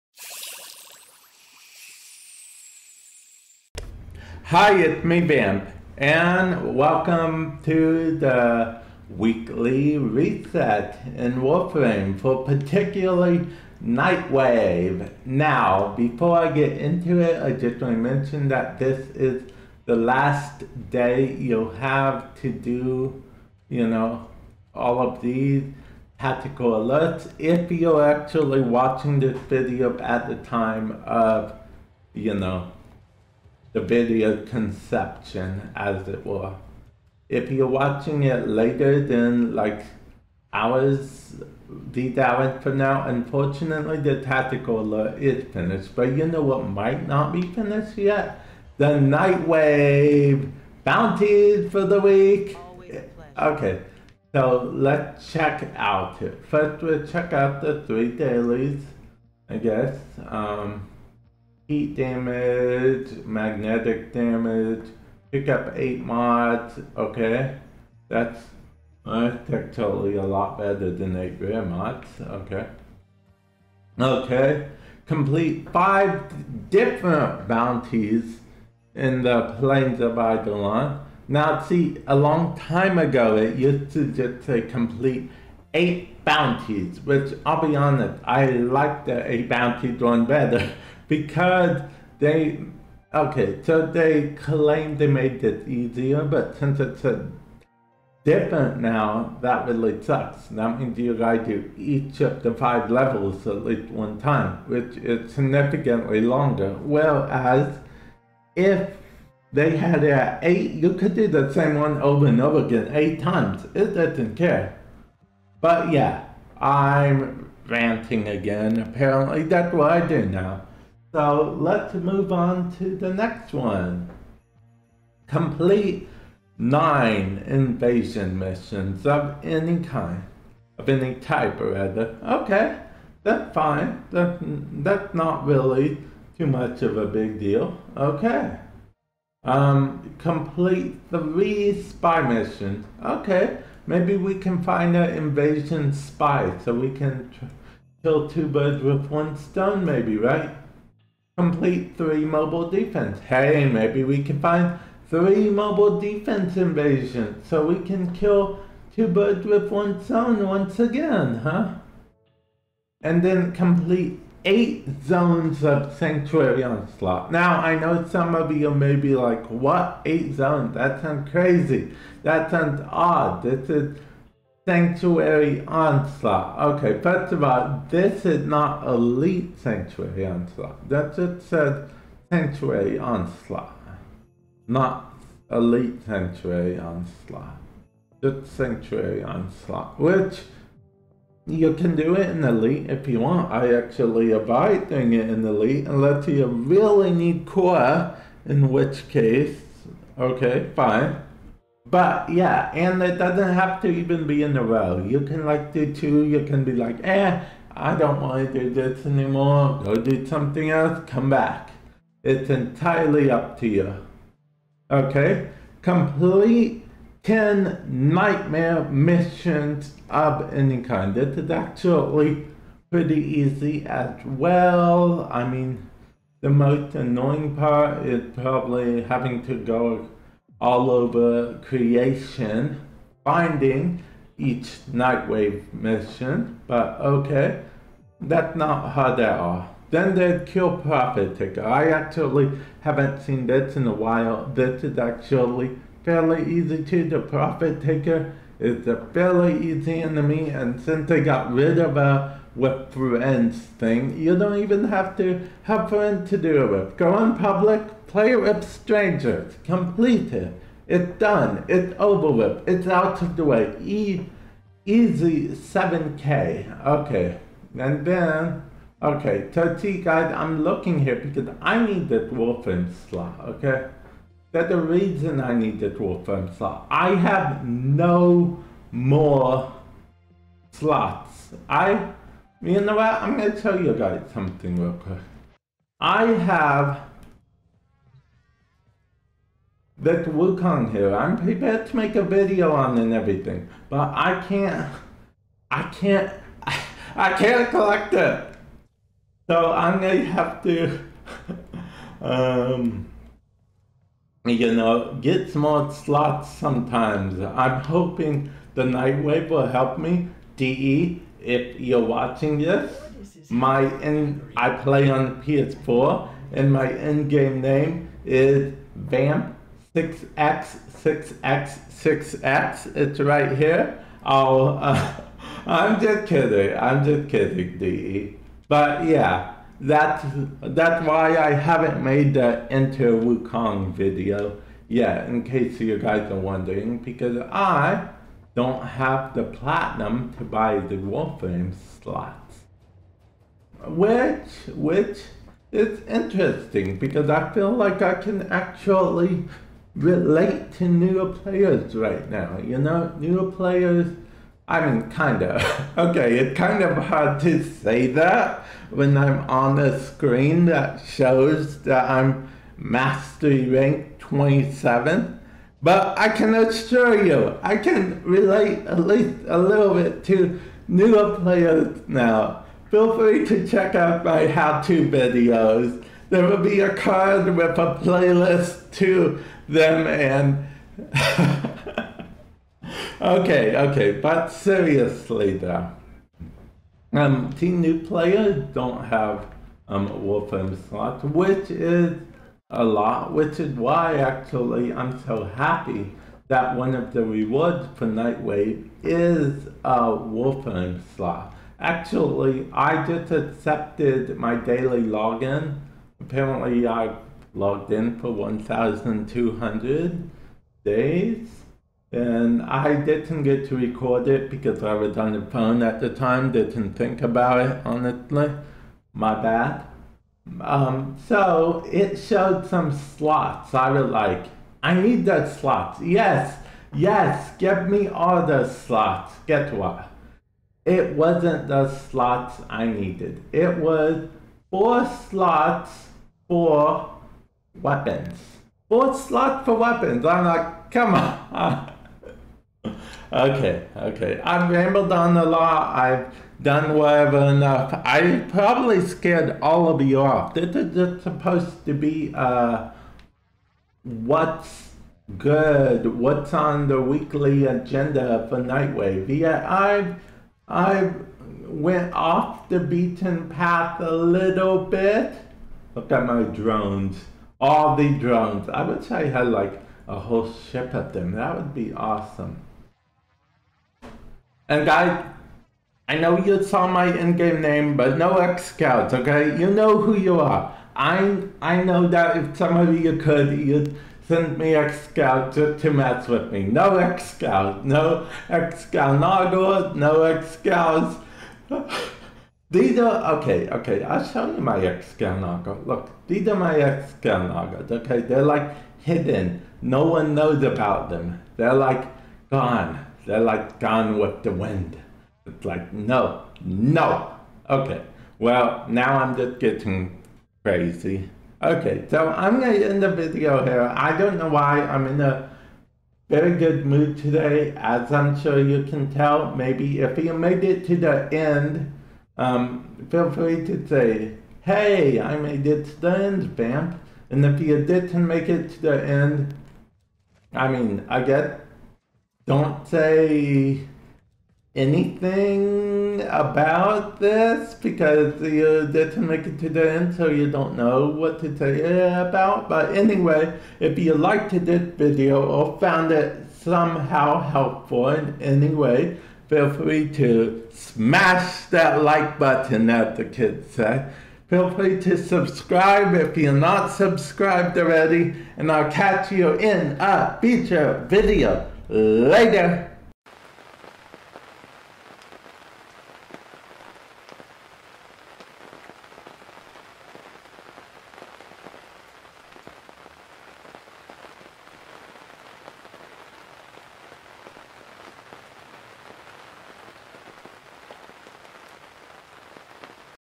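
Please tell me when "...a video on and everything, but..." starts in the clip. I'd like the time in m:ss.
4:52.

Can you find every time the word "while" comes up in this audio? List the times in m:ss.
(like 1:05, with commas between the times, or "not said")
4:03.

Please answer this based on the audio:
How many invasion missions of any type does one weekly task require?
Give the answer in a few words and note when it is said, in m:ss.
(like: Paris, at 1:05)
9, at 2:06.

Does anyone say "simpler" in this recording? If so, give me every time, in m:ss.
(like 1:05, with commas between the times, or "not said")
not said.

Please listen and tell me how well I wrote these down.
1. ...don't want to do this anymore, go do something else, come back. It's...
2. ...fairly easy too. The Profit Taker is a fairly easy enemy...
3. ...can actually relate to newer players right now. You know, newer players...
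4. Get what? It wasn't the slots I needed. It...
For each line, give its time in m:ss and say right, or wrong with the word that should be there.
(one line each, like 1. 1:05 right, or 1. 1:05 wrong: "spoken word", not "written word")
1. 3:27 right
2. 4:06 right
3. 5:48 right
4. 7:09 right.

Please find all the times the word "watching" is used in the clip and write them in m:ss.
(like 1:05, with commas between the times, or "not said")
0:28, 0:37, 5:12.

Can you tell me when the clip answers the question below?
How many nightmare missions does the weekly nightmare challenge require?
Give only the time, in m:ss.
3:37.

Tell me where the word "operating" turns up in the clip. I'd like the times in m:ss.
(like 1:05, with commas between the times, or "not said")
not said.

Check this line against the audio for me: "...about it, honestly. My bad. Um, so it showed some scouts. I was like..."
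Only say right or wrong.
wrong.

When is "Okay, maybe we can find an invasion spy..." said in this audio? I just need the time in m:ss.
2:23.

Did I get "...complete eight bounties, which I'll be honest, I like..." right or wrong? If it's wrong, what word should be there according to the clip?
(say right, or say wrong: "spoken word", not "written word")
right.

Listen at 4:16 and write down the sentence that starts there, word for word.
Go in public, play with strangers, complete it.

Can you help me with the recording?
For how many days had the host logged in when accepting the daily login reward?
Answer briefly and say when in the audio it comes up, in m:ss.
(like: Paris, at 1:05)
1,200, at 6:48.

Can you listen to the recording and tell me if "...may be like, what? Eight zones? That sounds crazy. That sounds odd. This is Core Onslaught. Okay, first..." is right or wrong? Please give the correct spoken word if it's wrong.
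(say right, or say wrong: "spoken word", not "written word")
wrong: "Sanctuary", not "Core".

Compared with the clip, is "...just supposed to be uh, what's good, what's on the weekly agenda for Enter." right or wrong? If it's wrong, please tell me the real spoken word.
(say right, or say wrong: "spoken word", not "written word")
wrong: "Nightwave", not "Enter".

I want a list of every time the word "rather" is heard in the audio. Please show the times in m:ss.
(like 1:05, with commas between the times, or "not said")
2:11.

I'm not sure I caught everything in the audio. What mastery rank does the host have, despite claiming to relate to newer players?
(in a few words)
27.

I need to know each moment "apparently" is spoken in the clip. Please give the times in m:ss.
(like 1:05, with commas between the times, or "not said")
1:58, 6:46.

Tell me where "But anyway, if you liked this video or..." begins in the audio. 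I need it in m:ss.
9:02.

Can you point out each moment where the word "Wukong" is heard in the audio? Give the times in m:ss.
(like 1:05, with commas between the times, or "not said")
4:50, 5:33.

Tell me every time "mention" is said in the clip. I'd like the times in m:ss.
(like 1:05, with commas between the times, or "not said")
0:18.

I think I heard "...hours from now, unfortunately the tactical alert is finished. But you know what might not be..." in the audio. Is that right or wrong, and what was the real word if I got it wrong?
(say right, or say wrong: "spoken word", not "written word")
right.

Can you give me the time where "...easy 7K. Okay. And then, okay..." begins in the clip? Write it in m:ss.
4:24.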